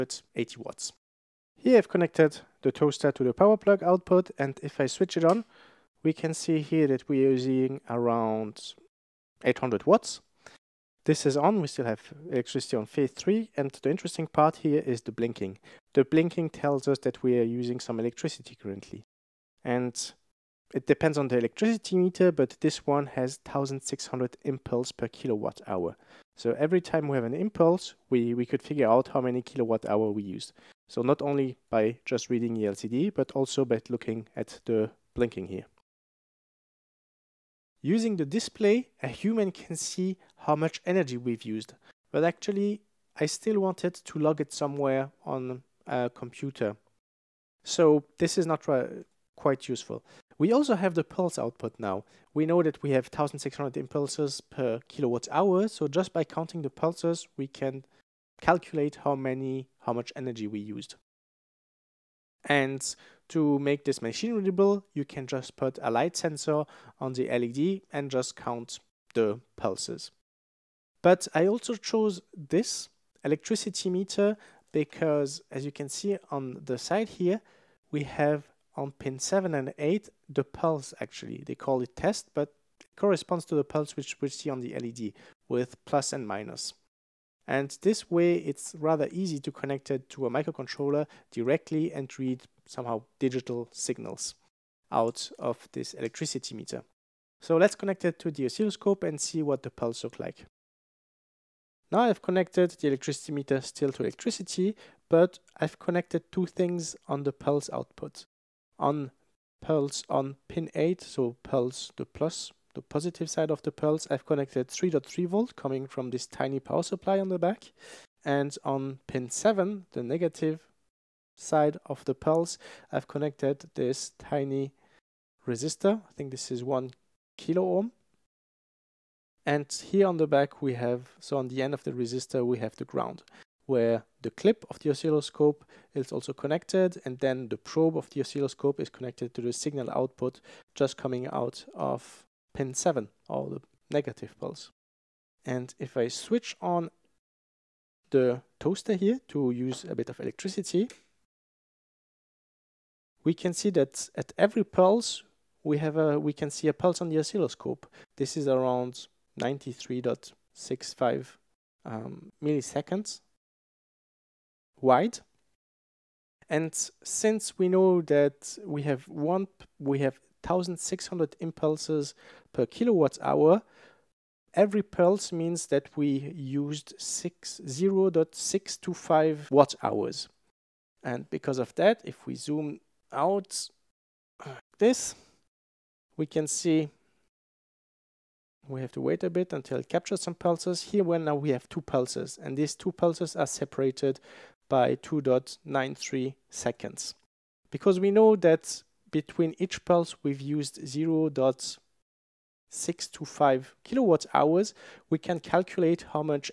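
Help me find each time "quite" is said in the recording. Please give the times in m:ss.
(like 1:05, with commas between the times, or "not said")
0:49.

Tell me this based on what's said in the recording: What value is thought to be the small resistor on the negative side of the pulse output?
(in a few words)
1 kilo ohm.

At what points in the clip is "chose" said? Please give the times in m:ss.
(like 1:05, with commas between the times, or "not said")
1:11.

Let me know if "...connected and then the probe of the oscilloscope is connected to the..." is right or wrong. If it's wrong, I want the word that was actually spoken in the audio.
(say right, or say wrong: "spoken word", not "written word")
right.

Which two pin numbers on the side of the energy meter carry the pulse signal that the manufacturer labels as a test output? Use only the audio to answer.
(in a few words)
7 and 8.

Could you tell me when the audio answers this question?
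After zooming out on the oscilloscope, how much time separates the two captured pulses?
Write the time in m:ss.
3:14.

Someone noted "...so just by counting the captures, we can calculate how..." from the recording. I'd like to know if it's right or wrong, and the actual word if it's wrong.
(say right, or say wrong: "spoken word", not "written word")
wrong: "pulses", not "captures".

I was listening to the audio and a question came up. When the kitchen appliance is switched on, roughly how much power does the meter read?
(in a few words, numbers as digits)
800 watts.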